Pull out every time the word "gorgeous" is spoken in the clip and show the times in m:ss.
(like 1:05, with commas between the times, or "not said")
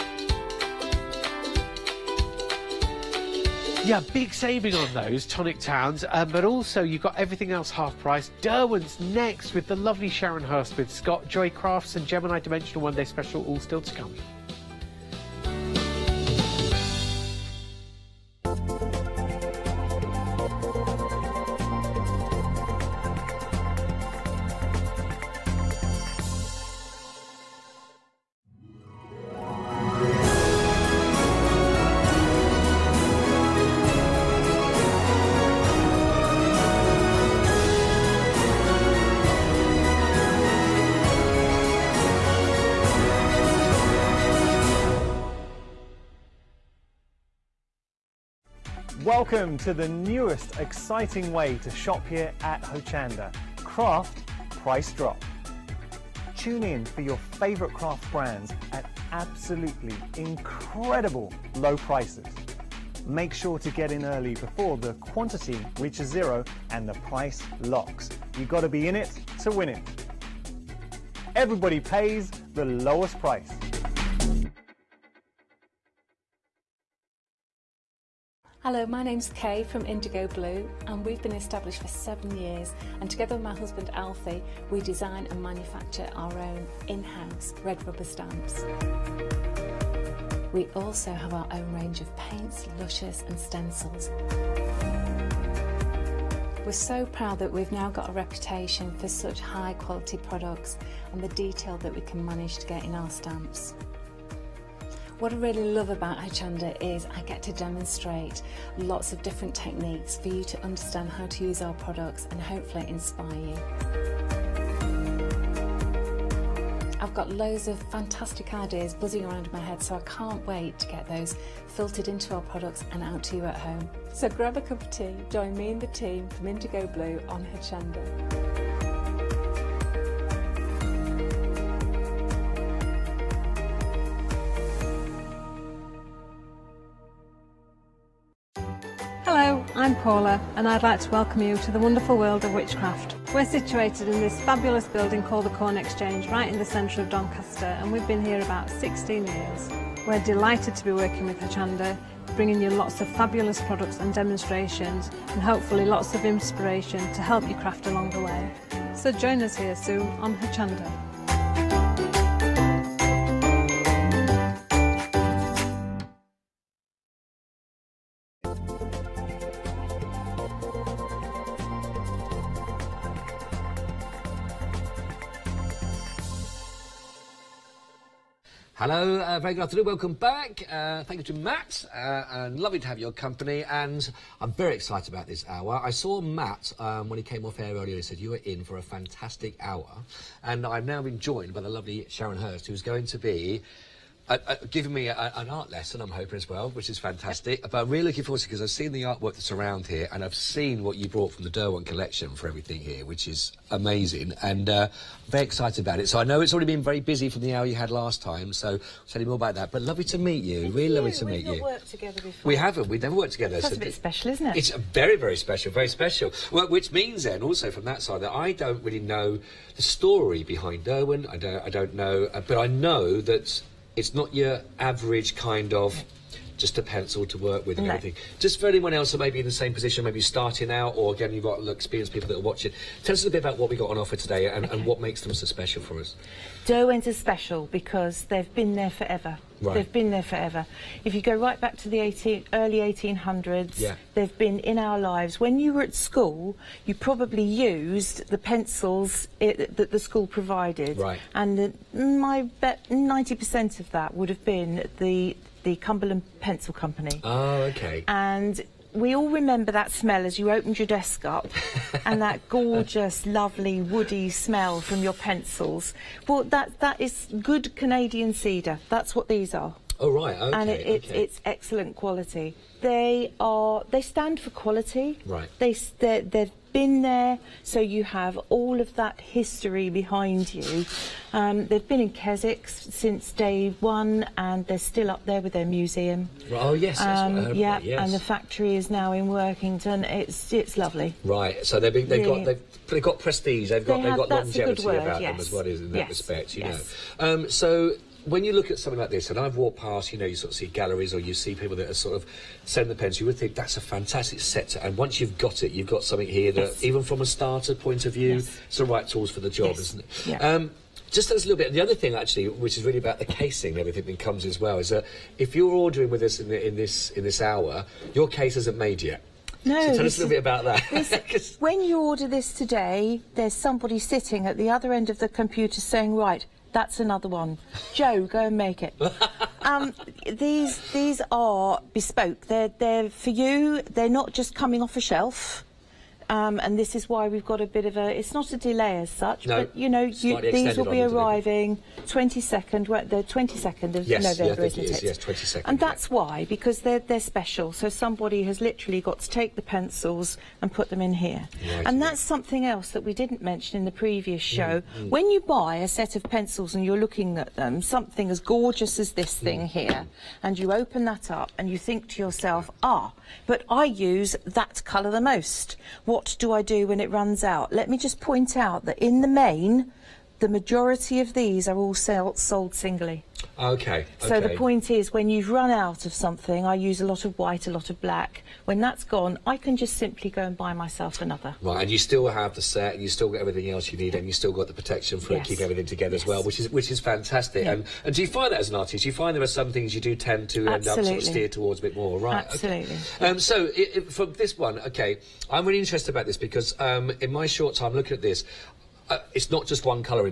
4:22, 5:58.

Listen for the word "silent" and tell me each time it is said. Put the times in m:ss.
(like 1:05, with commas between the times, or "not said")
not said.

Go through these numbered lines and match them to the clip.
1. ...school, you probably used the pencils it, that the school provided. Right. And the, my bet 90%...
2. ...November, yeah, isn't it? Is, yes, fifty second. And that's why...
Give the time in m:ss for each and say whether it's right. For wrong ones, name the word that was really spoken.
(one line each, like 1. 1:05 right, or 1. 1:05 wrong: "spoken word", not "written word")
1. 4:05 right
2. 5:44 wrong: "twenty", not "fifty".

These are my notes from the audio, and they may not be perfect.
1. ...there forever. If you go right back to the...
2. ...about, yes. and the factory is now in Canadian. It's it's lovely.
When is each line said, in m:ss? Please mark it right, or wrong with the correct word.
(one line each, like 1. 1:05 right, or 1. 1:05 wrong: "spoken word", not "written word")
1. 4:00 right
2. 4:47 wrong: "Workington", not "Canadian".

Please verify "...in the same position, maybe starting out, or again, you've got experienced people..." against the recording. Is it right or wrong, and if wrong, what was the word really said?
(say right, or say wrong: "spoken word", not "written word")
right.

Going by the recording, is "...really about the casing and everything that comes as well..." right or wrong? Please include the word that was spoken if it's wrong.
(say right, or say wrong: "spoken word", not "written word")
right.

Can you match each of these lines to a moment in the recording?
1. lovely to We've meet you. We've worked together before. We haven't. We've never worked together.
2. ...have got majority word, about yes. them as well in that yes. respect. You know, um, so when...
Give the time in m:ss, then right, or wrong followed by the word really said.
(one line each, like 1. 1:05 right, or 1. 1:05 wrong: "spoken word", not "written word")
1. 3:30 right
2. 4:54 wrong: "longevity", not "majority".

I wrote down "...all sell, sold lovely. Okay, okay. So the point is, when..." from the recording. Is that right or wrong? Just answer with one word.
wrong.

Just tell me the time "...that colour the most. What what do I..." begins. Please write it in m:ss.
6:04.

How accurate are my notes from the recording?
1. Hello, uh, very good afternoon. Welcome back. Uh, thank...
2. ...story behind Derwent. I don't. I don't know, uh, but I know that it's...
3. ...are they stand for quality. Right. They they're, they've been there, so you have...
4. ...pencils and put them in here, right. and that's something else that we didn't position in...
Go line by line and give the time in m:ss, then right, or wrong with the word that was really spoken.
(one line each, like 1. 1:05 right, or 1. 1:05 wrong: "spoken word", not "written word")
1. 2:58 right
2. 3:39 right
3. 4:33 right
4. 5:49 wrong: "mention", not "position".